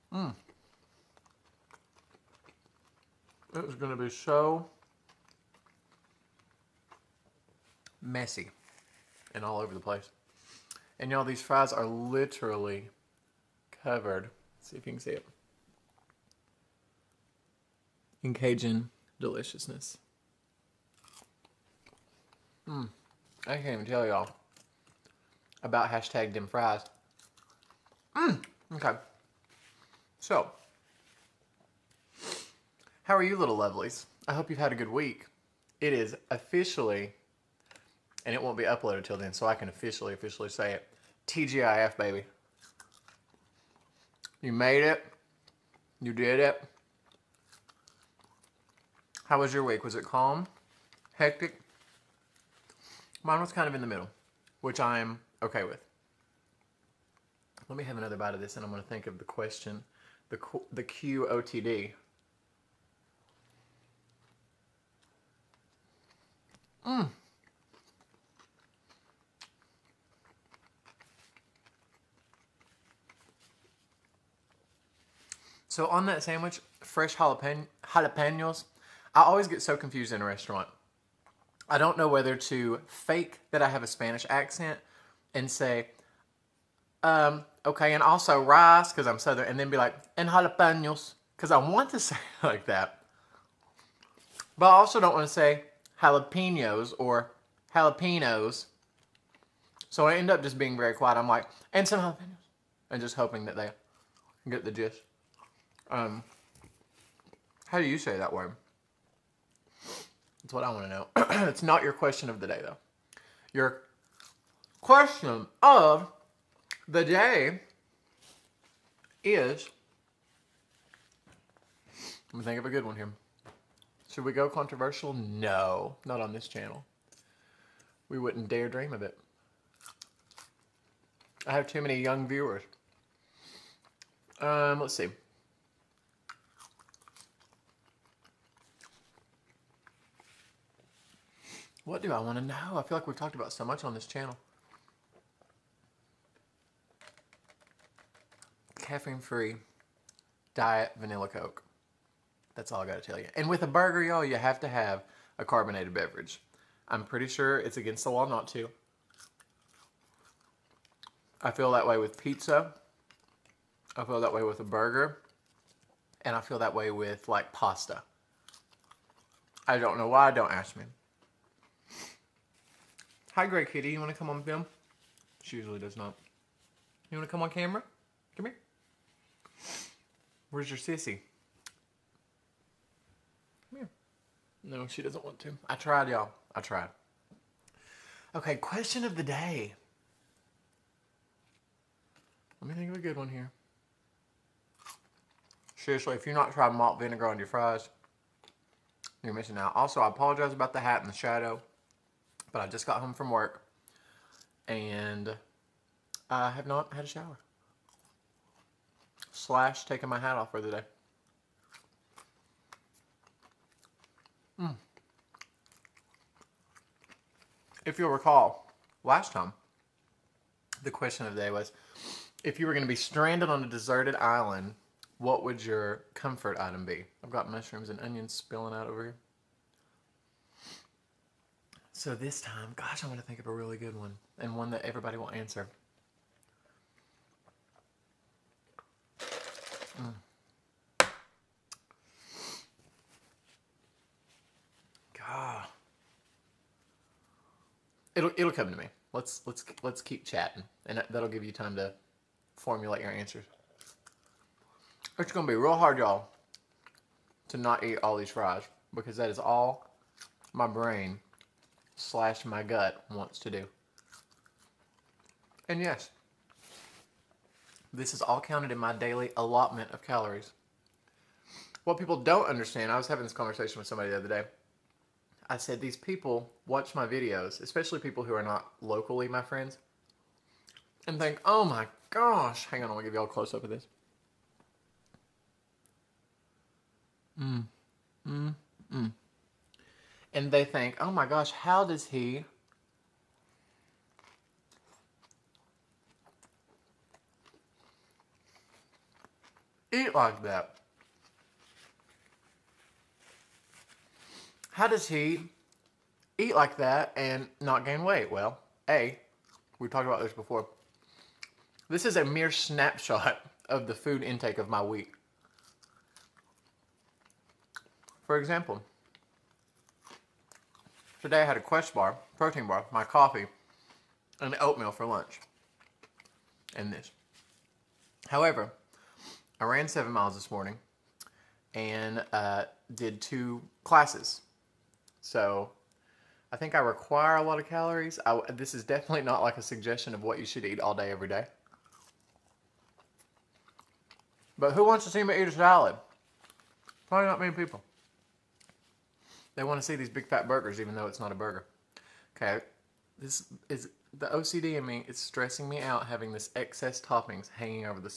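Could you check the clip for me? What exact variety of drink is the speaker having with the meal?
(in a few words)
Caffeine-free diet vanilla Coke.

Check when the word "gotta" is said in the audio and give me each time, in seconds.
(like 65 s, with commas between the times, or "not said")
152 s.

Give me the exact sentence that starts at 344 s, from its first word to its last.
But who wants to see me eat a salad?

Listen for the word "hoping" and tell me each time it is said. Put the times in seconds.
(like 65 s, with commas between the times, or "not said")
103 s.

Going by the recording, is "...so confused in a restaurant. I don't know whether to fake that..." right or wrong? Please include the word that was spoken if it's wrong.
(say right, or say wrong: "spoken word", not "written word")
right.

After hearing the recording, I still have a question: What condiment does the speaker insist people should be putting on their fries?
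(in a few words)
malt vinegar.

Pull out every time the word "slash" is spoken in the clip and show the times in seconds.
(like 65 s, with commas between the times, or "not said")
209 s, 261 s.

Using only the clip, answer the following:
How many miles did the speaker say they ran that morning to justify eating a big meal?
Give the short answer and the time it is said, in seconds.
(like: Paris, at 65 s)
7, at 329 s.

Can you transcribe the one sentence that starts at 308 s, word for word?
Well, A, we talked about this before.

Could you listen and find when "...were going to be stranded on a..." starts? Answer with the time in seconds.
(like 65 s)
222 s.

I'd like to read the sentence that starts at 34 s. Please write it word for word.
I hope you've had a good week.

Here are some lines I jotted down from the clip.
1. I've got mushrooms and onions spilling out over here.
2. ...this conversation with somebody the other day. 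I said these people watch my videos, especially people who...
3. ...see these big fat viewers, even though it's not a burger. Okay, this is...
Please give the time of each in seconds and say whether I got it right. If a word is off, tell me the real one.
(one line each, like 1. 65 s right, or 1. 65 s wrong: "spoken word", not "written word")
1. 227 s right
2. 273 s right
3. 349 s wrong: "burgers", not "viewers".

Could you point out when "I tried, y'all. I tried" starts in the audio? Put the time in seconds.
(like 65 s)
185 s.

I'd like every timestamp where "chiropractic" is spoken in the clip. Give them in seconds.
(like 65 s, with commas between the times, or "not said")
not said.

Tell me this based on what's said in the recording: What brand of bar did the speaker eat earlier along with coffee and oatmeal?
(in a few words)
Quest bar.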